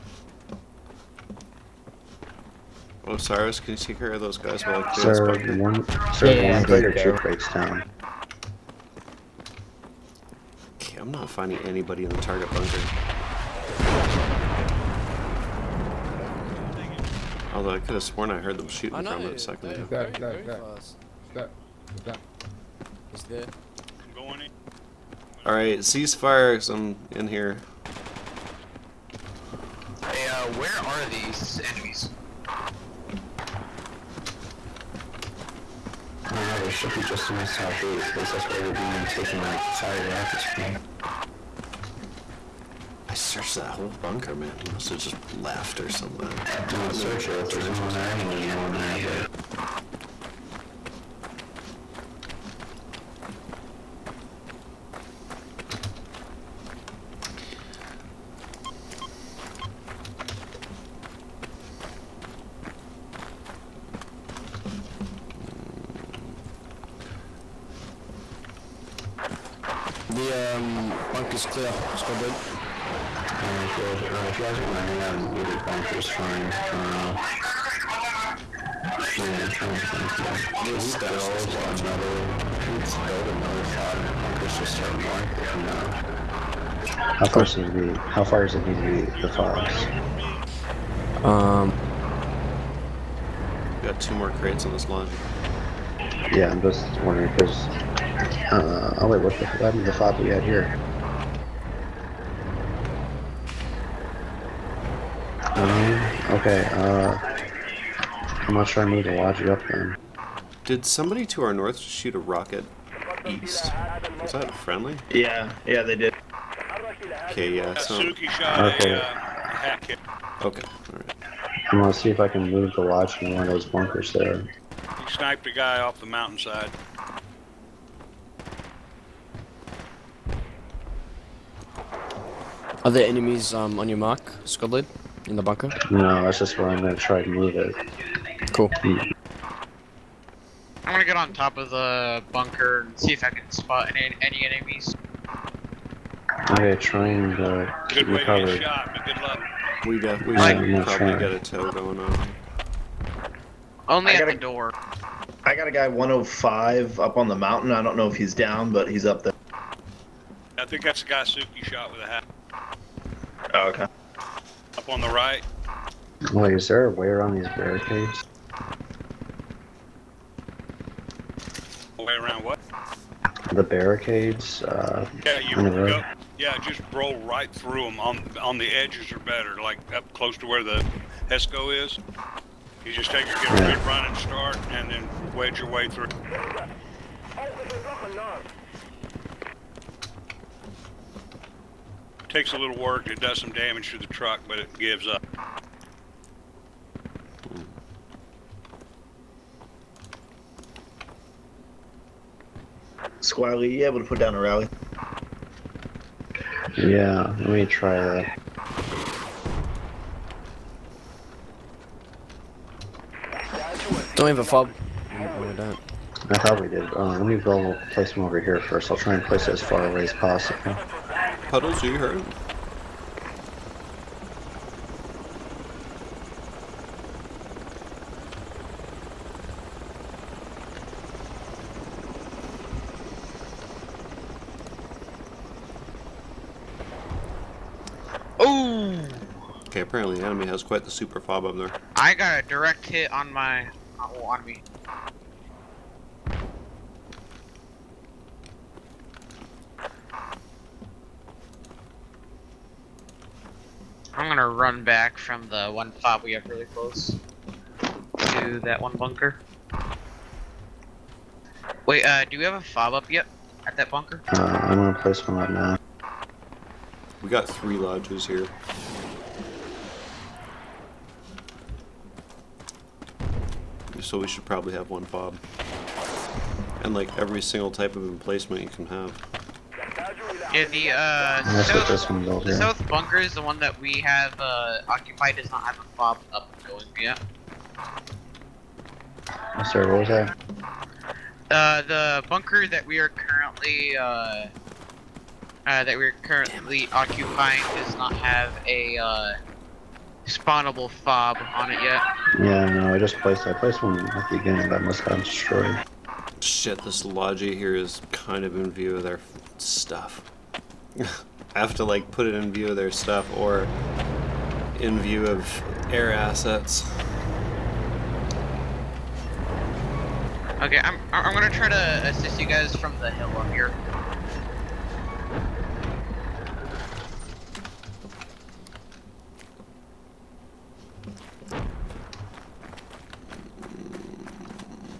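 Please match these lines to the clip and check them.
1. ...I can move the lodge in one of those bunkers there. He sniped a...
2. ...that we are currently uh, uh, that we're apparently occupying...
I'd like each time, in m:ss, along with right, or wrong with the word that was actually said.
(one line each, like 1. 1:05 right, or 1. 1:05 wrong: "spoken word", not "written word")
1. 2:02 right
2. 4:52 wrong: "currently", not "apparently".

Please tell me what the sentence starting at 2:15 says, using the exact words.
No, that's just where I'm gonna try to move it.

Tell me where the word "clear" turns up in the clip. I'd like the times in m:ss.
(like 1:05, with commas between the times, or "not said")
0:04, 1:11.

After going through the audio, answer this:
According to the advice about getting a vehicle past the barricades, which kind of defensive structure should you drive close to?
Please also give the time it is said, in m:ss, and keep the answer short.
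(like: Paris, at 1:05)
Hesco, at 3:01.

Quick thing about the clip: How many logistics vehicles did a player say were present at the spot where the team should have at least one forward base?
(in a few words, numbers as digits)
3.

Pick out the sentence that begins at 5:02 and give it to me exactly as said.
Yeah, no, I just placed I placed one at the beginning that must have destroyed.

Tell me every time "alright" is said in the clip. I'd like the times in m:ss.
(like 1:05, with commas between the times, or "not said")
0:25, 1:13, 2:00.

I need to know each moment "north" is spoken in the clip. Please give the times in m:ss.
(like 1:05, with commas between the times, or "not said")
1:25, 1:51.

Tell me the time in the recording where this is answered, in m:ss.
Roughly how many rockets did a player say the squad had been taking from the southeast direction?
0:39.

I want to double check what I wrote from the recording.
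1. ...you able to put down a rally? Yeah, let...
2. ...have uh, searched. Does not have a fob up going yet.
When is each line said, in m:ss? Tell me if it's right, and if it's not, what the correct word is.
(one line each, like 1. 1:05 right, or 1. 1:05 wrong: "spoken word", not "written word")
1. 3:23 right
2. 4:44 wrong: "occupied", not "searched".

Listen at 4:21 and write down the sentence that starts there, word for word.
Wait, uh, do we have a fob up yet at that bunker?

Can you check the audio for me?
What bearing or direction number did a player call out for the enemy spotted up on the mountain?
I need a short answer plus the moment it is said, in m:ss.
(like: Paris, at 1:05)
105, at 2:35.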